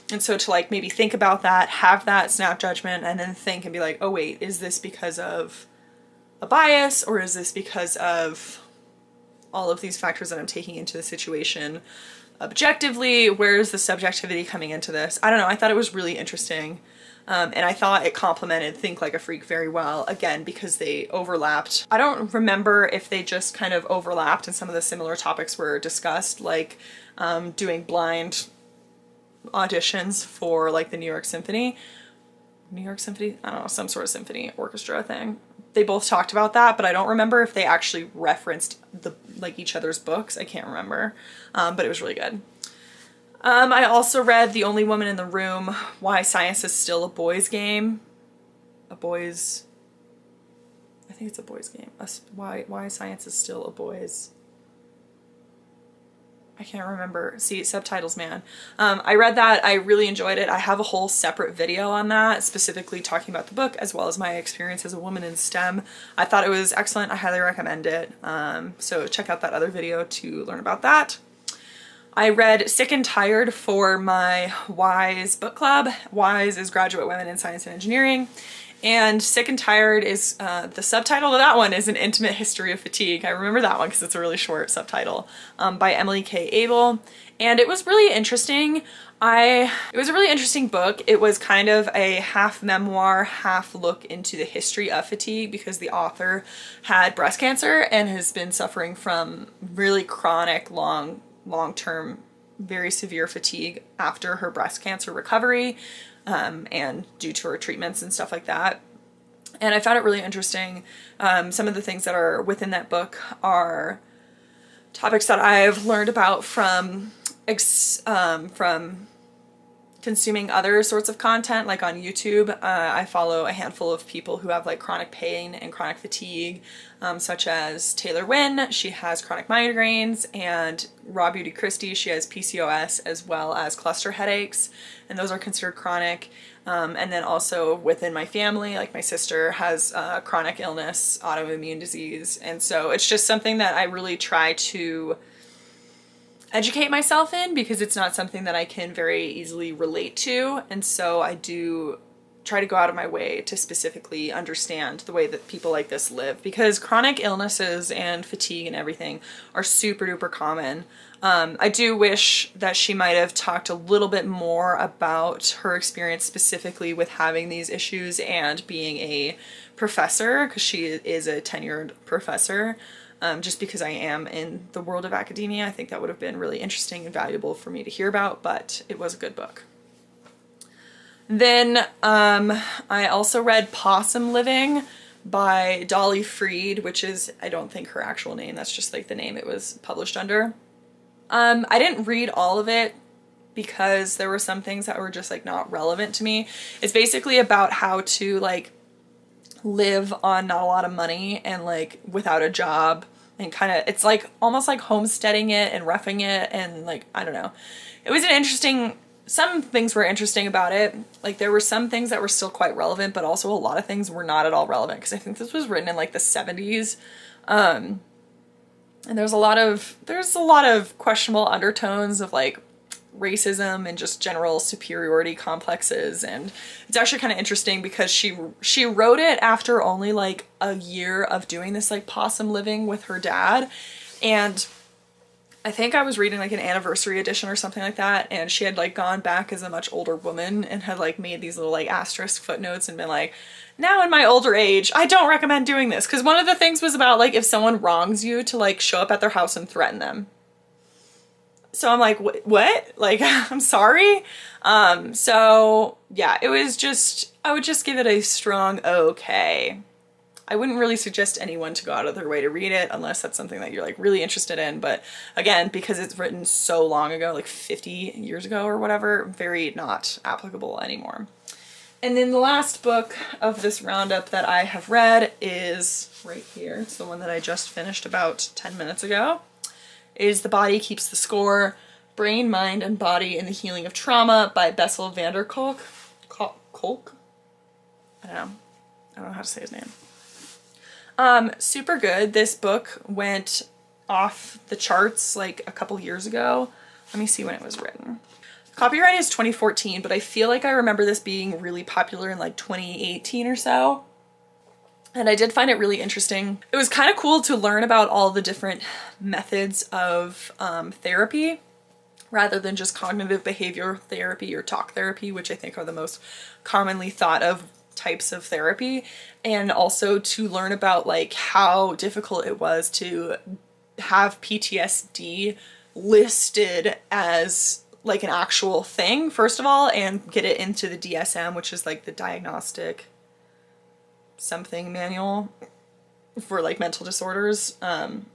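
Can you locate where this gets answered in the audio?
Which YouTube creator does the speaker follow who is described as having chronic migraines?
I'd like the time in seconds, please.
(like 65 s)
127 s.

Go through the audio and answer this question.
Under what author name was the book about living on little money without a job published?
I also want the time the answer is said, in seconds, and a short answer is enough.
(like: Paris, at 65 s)
Dolly Freed, at 185 s.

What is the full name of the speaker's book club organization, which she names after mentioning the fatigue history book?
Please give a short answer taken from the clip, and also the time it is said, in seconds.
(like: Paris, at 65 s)
Graduate Women in Science and Engineering, at 76 s.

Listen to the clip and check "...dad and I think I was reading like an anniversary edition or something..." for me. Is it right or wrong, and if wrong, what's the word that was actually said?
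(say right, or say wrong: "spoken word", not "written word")
right.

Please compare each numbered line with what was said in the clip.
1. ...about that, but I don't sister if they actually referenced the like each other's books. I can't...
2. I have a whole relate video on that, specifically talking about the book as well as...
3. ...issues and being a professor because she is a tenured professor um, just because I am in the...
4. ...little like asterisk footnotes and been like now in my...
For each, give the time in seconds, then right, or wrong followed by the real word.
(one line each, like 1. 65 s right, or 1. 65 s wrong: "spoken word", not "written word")
1. 36 s wrong: "remember", not "sister"
2. 60 s wrong: "separate", not "relate"
3. 167 s right
4. 241 s right.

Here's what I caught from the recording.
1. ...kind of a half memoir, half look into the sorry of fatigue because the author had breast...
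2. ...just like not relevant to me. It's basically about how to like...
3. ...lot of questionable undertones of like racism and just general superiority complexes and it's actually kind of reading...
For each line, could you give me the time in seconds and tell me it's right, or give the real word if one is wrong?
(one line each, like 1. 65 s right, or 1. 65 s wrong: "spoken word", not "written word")
1. 91 s wrong: "history", not "sorry"
2. 195 s right
3. 220 s wrong: "interesting", not "reading".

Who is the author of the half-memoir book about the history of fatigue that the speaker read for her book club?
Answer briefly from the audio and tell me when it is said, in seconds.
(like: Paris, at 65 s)
Emily K. Abel, at 85 s.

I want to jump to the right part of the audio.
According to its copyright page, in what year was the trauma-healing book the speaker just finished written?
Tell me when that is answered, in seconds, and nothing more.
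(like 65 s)
299 s.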